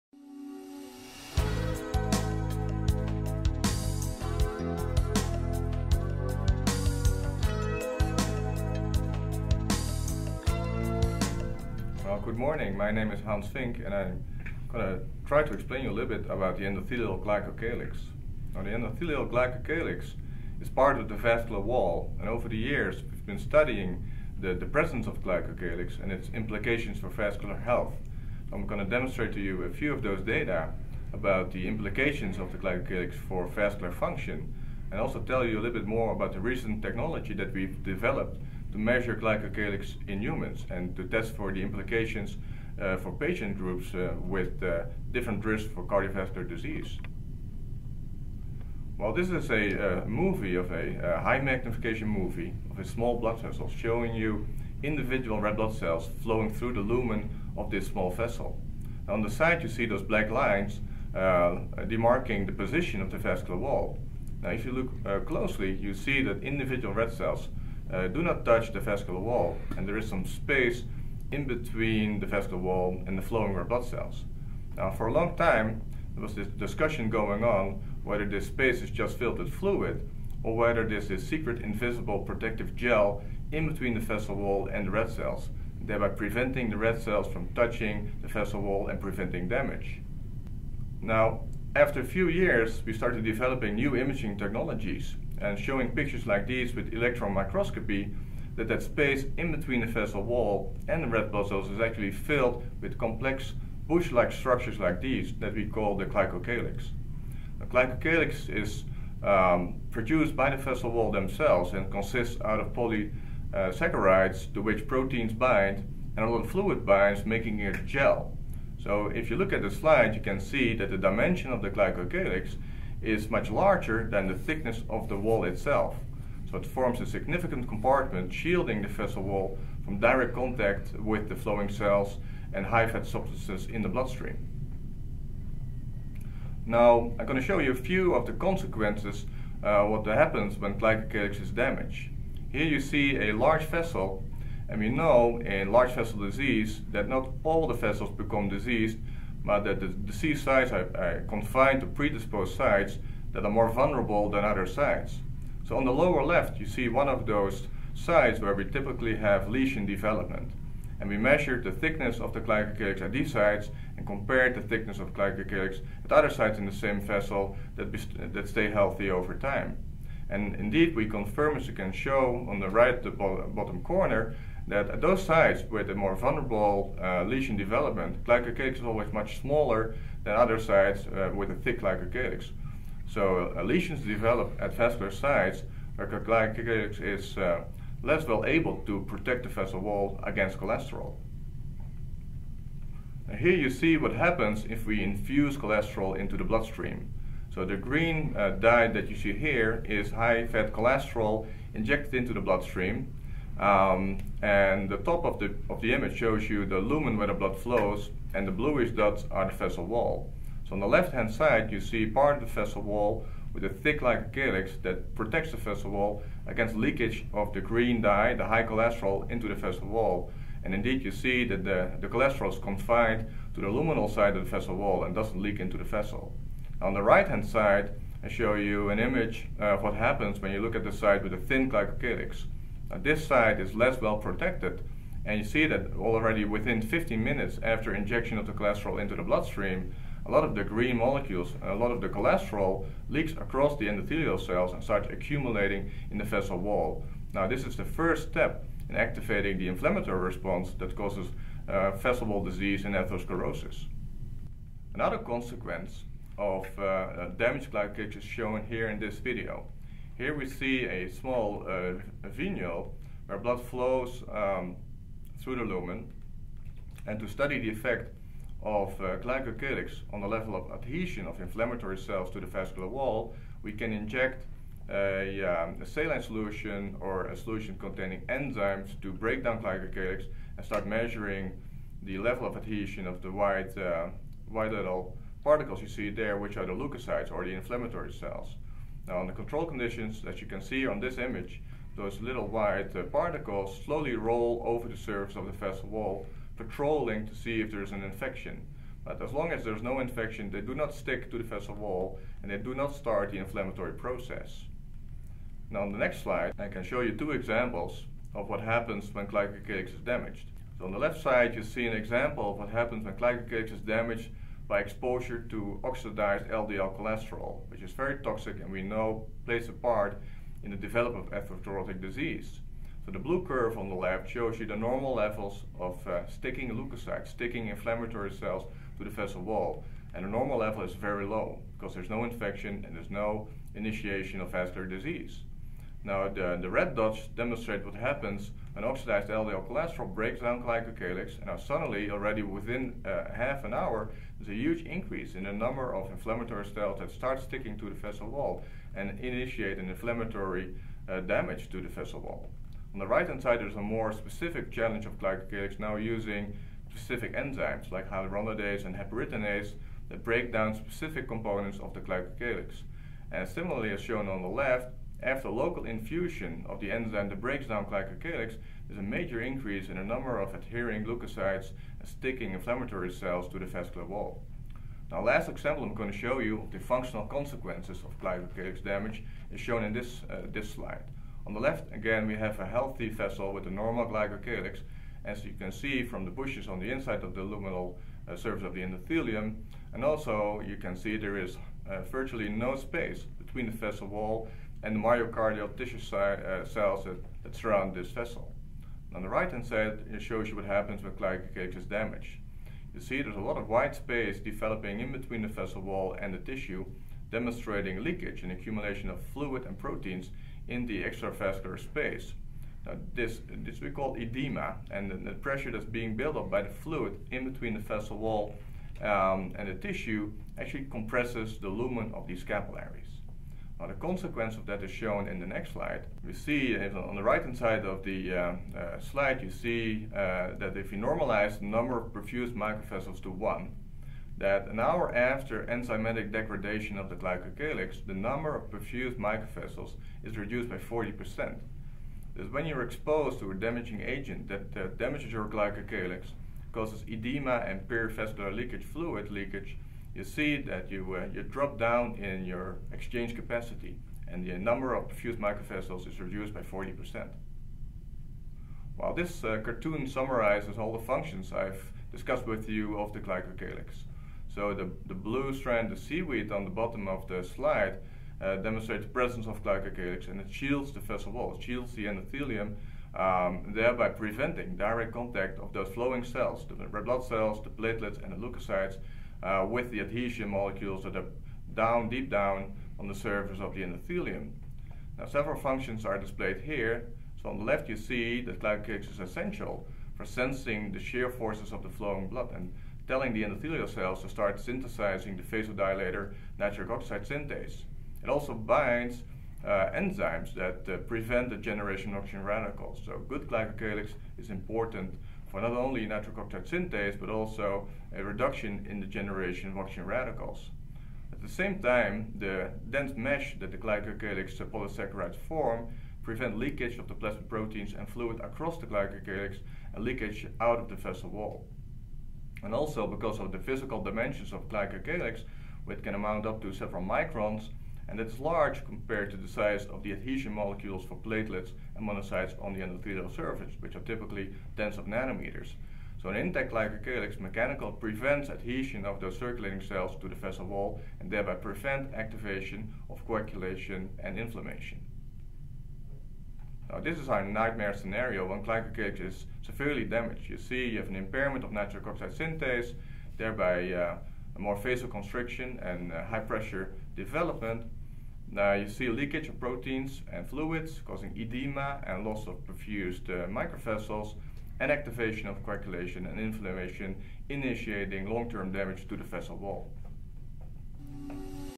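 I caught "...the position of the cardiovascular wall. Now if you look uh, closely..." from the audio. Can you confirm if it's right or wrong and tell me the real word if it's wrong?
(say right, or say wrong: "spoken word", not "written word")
wrong: "vascular", not "cardiovascular".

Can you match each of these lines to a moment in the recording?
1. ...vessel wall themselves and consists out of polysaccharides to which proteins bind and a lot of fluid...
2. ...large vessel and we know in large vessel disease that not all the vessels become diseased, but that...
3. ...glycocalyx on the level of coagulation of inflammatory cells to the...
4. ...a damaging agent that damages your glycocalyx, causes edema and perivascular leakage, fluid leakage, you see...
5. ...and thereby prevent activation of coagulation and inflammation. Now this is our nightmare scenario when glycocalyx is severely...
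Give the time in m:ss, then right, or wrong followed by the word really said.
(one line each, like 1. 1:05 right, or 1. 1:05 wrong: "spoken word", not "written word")
1. 1:50 right
2. 2:23 right
3. 4:29 wrong: "adhesion", not "coagulation"
4. 7:23 right
5. 9:01 right.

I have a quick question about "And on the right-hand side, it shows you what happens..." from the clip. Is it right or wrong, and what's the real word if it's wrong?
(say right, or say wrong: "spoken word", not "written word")
right.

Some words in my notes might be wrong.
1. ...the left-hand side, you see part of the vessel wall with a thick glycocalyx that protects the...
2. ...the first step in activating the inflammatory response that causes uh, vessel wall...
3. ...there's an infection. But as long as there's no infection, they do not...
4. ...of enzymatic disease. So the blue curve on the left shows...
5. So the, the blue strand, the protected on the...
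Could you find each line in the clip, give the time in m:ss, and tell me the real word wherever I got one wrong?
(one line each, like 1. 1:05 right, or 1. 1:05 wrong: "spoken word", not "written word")
1. 3:30 right
2. 4:07 right
3. 4:57 right
4. 5:21 wrong: "atherosclerotic", not "enzymatic"
5. 7:44 wrong: "seaweed", not "protected".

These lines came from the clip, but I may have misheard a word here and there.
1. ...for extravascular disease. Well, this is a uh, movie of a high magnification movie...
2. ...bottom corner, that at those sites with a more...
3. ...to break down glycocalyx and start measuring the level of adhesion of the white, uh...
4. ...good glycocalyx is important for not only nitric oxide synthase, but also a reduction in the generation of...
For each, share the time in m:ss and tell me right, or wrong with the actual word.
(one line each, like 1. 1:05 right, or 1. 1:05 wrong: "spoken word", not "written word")
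1. 0:45 wrong: "cardiovascular", not "extravascular"
2. 2:53 right
3. 4:39 right
4. 8:23 right.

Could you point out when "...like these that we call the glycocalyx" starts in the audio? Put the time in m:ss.
1:44.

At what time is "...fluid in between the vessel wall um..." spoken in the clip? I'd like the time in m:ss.
6:56.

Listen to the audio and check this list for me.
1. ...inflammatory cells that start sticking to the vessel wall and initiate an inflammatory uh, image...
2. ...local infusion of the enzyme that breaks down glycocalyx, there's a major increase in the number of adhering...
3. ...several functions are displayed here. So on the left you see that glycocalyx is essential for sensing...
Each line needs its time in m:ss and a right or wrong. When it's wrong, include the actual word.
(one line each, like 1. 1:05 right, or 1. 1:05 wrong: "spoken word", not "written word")
1. 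5:46 wrong: "damage", not "image"
2. 6:05 right
3. 8:05 right.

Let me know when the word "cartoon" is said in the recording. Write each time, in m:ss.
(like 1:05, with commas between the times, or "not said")
7:39.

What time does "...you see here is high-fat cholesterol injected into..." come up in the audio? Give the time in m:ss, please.
3:19.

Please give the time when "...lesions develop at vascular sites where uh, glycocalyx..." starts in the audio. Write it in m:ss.
3:03.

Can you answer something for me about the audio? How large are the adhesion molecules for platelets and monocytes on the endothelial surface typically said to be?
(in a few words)
tens of nanometers.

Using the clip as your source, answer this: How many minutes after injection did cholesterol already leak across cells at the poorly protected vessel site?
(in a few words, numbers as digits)
15.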